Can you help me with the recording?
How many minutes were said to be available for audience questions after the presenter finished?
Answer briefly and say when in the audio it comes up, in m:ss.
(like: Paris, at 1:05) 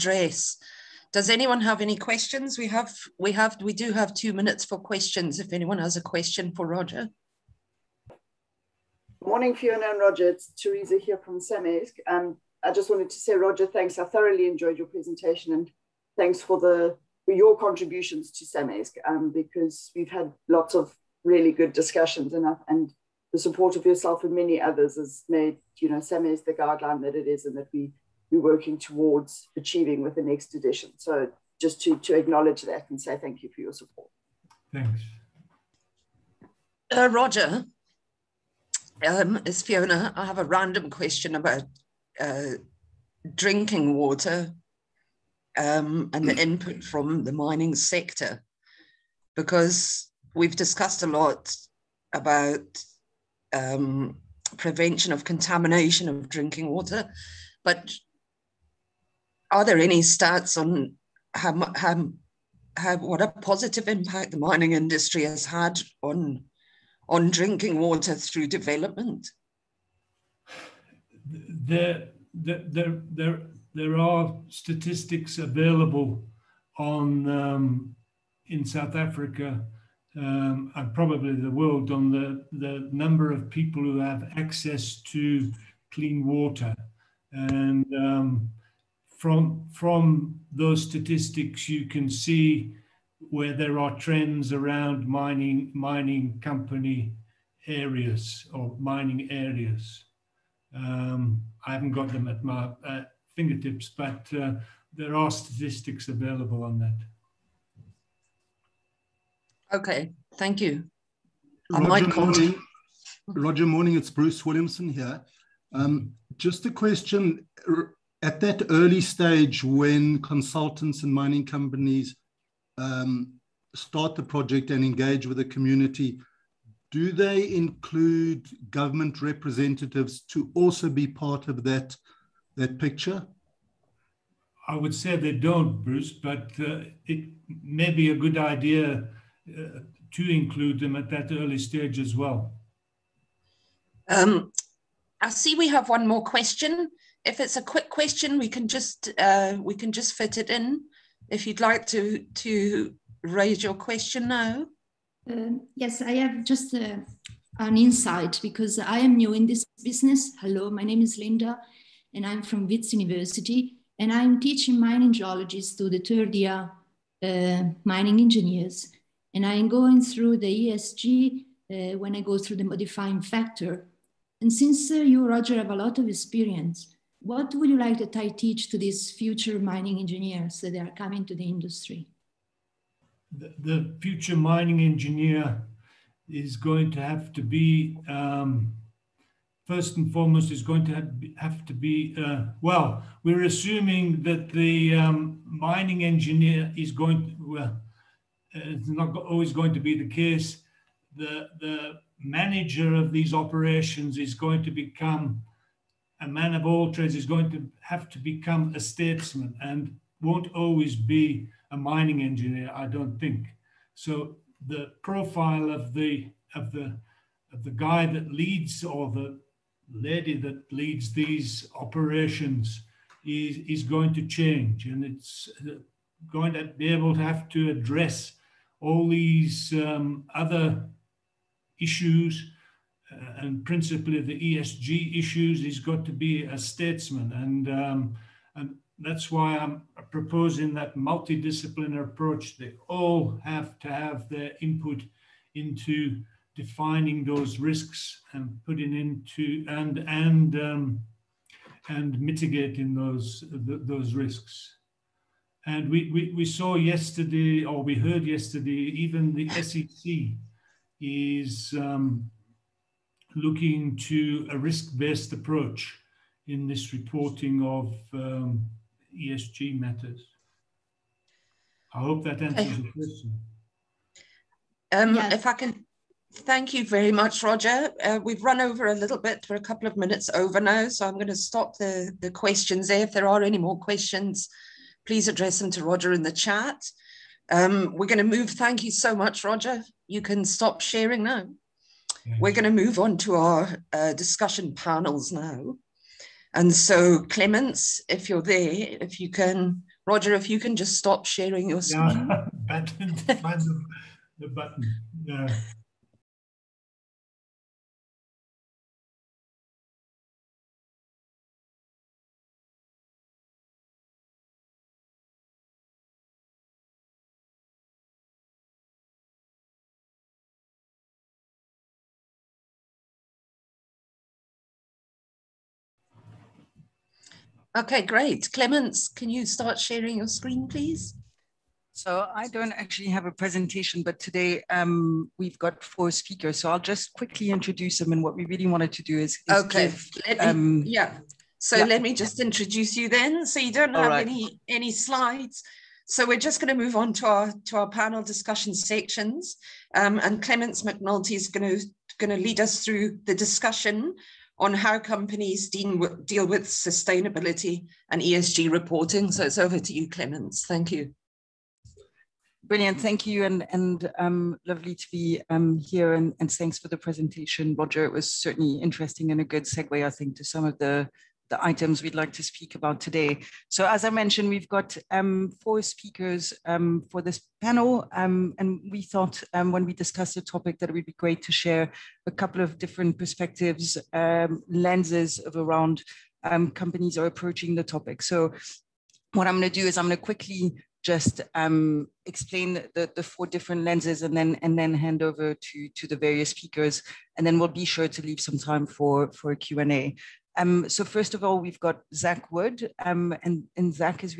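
2, at 0:04.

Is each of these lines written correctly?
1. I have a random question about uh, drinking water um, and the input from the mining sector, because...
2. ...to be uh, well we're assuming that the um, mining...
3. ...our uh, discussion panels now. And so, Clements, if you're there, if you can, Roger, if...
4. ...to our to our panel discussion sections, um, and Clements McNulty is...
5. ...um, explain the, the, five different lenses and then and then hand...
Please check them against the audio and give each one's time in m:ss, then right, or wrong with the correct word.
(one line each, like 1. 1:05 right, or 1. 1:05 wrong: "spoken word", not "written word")
1. 0:40 right
2. 3:11 right
3. 4:53 right
4. 5:47 right
5. 6:31 wrong: "four", not "five".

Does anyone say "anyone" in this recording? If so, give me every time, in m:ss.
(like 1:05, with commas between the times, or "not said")
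0:01, 0:05.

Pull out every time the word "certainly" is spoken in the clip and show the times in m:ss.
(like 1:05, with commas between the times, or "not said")
6:08.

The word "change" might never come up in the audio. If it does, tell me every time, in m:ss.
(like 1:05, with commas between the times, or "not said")
3:44.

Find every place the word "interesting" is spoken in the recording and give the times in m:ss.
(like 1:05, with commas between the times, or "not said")
6:08.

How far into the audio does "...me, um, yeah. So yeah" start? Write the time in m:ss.
5:40.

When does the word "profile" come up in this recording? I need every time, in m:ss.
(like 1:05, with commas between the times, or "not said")
3:35.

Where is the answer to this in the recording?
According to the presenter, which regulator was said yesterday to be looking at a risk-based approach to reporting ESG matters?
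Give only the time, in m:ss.
4:19.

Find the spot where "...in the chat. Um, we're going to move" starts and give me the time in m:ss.
4:46.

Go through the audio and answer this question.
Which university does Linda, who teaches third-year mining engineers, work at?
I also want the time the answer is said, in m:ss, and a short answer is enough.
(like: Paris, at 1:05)
Wits University, at 2:42.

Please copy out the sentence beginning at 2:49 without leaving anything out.
And I'm going through the ESG uh, when I go through the modifying factor.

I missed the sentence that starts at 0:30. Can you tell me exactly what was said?
So just to, to acknowledge that and say thank you for your support.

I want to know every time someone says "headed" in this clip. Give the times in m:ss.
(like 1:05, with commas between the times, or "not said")
not said.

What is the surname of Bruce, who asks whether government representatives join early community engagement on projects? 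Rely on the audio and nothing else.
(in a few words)
Williamson.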